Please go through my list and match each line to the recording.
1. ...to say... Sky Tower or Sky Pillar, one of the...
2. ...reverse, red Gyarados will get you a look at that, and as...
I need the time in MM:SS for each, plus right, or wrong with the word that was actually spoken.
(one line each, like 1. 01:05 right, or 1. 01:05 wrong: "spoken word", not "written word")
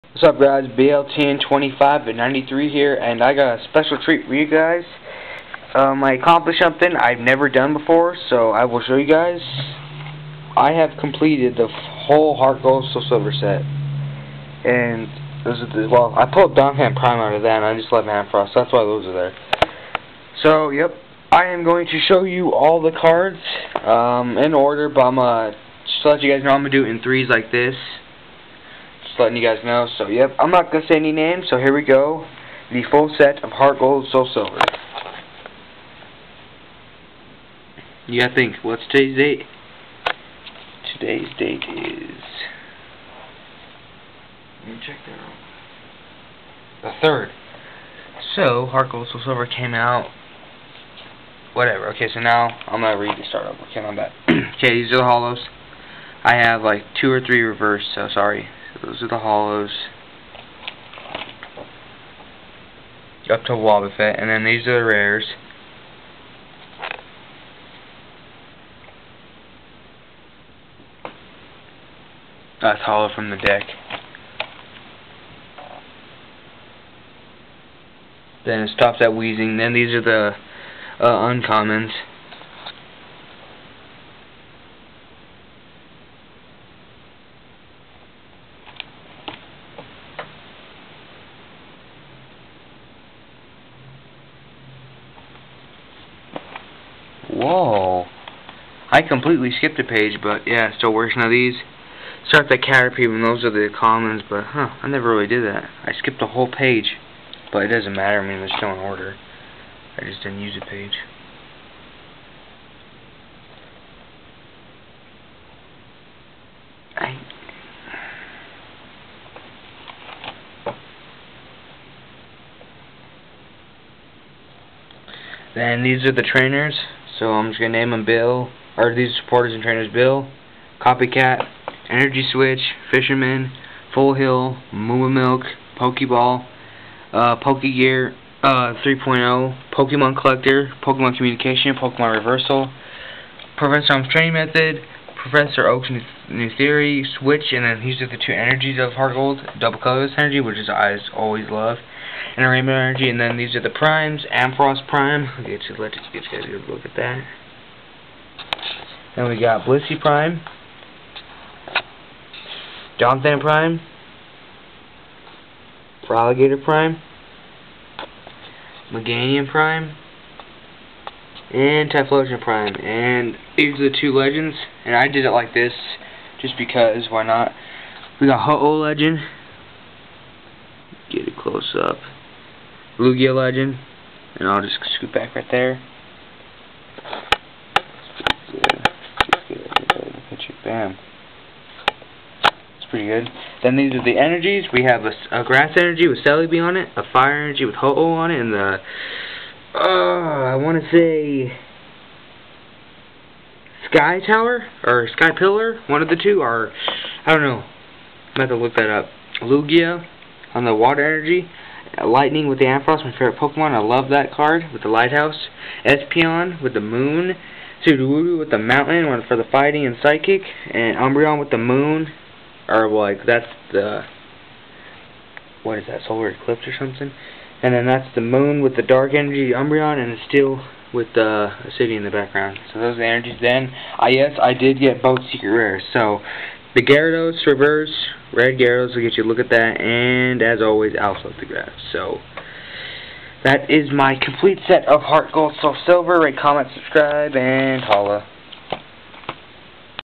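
1. 03:20 right
2. 03:57 right.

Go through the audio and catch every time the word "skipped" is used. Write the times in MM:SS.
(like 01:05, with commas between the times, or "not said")
01:39, 01:45.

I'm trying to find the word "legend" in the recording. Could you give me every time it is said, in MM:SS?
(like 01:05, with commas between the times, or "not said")
02:54, 02:58, 03:03.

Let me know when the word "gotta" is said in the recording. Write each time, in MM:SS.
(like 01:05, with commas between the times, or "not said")
00:38.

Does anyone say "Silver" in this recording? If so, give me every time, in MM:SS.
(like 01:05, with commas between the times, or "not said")
00:13, 00:34, 00:49, 04:05.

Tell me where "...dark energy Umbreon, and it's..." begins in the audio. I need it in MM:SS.
03:48.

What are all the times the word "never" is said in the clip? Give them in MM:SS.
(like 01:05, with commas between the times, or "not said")
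00:07, 01:44.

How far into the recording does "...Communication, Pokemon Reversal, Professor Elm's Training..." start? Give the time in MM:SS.
02:21.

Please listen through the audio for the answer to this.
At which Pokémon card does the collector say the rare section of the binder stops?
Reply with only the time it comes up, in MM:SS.
01:19.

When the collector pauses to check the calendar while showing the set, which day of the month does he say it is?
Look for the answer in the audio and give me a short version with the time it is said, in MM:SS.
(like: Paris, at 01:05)
3rd, at 00:46.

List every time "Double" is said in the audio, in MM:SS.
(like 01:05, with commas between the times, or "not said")
02:29.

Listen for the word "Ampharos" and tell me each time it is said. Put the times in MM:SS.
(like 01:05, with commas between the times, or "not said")
02:34, 03:32.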